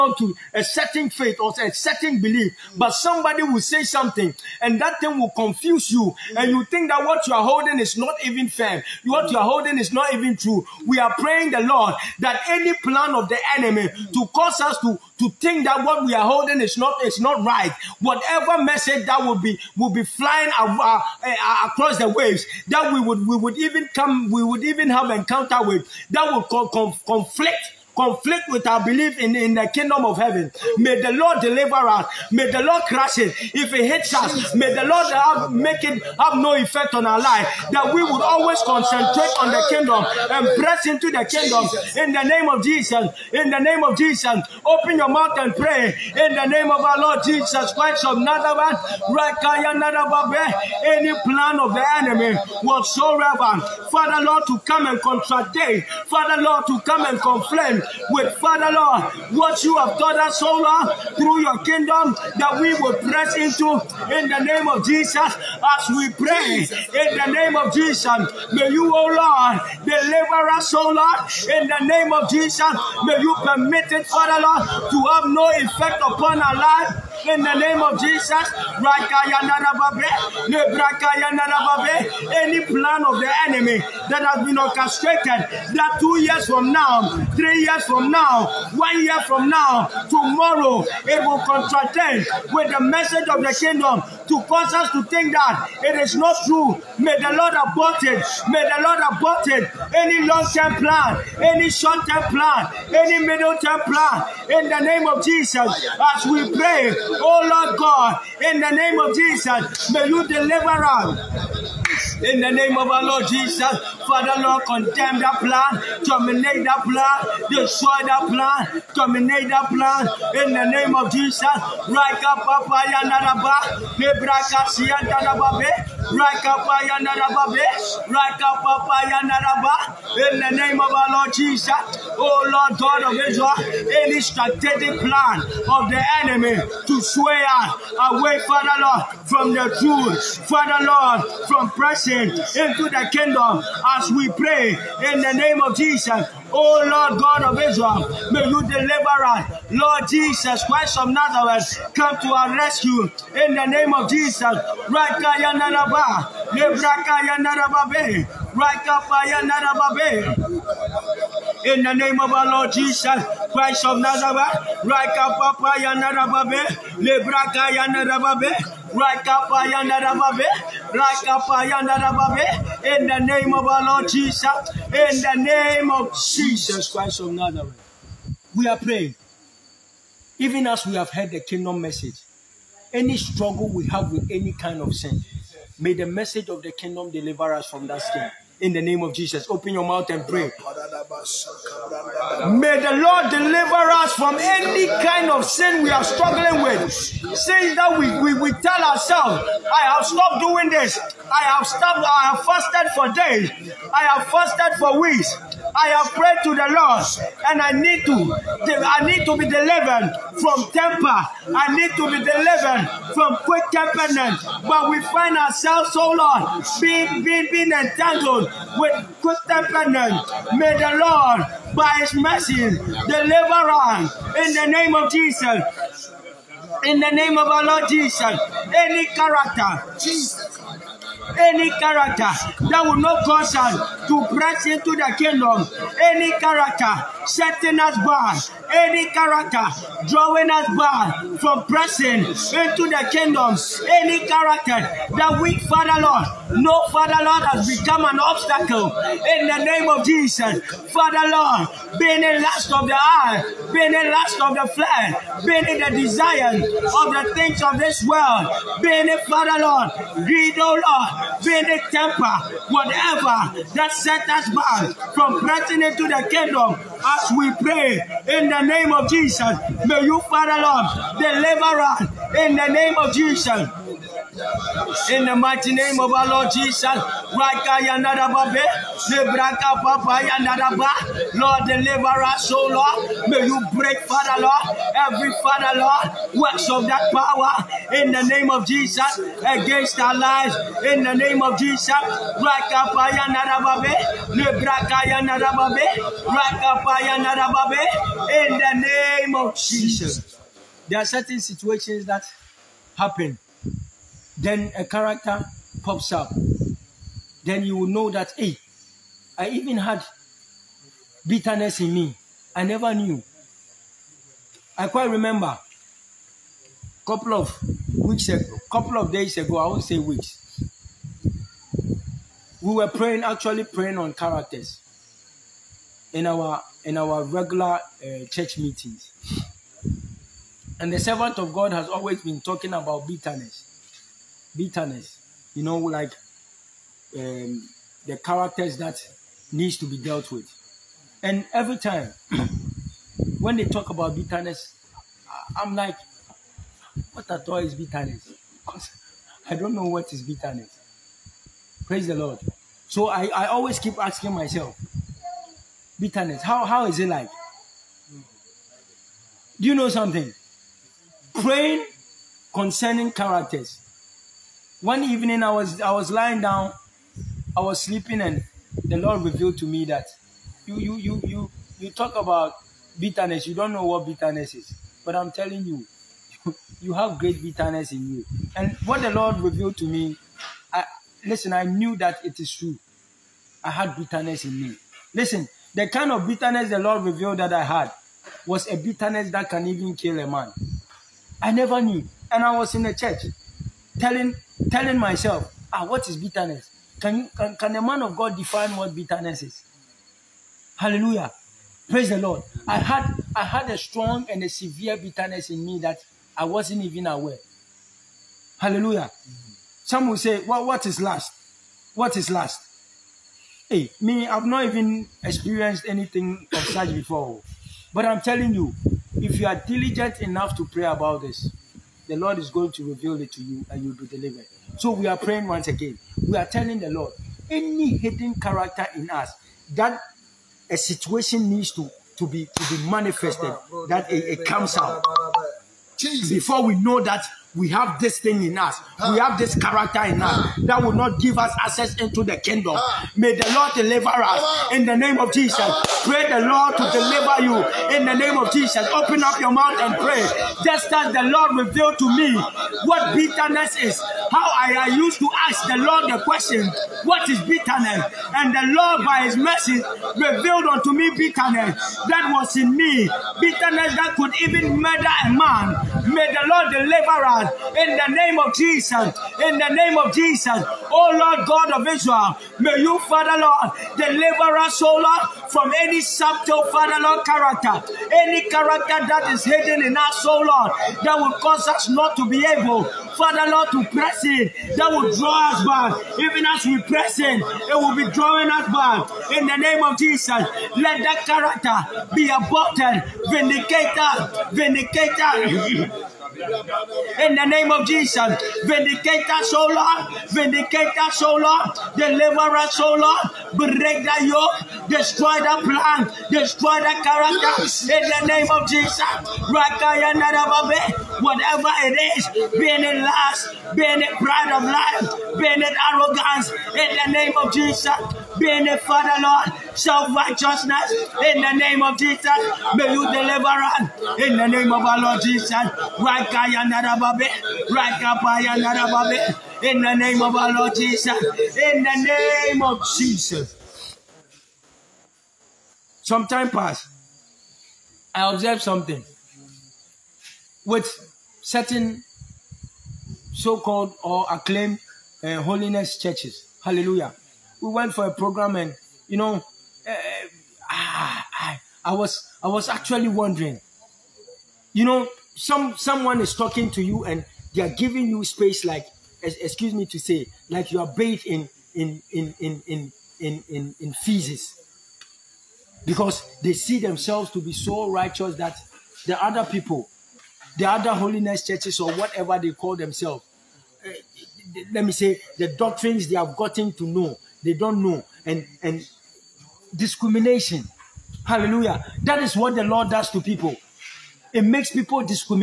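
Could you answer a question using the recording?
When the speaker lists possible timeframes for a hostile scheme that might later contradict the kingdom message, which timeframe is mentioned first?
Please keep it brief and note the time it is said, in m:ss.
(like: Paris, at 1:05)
Two years from now, at 1:25.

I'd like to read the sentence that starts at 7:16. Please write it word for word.
Before we know that we have this thing in us.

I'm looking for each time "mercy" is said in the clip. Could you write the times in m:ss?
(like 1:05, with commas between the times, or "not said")
3:42, 7:39.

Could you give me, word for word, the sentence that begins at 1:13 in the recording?
May you permit it, Father Lord, to have no effect upon our life in the name of Jesus.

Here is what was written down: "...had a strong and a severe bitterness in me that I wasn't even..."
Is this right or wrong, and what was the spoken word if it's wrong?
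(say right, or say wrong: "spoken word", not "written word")
right.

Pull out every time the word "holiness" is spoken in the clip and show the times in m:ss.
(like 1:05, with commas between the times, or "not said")
9:05, 9:30.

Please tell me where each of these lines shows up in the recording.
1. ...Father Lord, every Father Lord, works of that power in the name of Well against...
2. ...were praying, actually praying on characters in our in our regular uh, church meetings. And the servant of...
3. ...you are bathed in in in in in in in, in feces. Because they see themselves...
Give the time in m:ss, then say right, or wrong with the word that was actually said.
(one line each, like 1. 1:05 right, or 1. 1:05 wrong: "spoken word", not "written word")
1. 4:44 wrong: "Jesus", not "Well"
2. 5:22 right
3. 9:20 right.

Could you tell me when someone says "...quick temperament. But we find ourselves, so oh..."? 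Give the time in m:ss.
3:33.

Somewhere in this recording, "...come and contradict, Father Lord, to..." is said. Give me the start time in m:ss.
0:54.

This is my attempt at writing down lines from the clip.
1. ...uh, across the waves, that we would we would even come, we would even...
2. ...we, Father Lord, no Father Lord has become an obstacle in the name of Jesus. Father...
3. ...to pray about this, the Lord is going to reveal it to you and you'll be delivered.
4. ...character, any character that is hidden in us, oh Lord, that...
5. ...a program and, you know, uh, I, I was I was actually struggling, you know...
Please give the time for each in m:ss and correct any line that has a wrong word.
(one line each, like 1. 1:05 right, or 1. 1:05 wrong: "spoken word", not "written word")
1. 0:21 right
2. 4:05 right
3. 7:00 right
4. 7:57 right
5. 9:08 wrong: "wondering", not "struggling".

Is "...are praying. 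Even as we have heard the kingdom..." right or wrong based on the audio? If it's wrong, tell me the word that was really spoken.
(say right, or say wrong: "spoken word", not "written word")
right.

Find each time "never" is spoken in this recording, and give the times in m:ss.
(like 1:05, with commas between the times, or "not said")
5:12, 6:31.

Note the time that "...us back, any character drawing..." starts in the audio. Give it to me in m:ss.
3:57.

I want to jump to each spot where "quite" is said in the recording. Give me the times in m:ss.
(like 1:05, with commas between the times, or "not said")
5:14.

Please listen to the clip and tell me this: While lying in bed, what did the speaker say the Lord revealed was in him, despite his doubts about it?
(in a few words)
Great bitterness.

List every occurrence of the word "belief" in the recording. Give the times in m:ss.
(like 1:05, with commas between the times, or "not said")
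0:02, 0:28.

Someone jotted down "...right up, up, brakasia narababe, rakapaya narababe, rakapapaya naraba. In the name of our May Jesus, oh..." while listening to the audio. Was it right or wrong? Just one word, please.
wrong.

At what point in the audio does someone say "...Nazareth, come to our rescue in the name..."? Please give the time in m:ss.
2:31.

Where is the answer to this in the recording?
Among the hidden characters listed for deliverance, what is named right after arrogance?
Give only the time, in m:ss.
8:39.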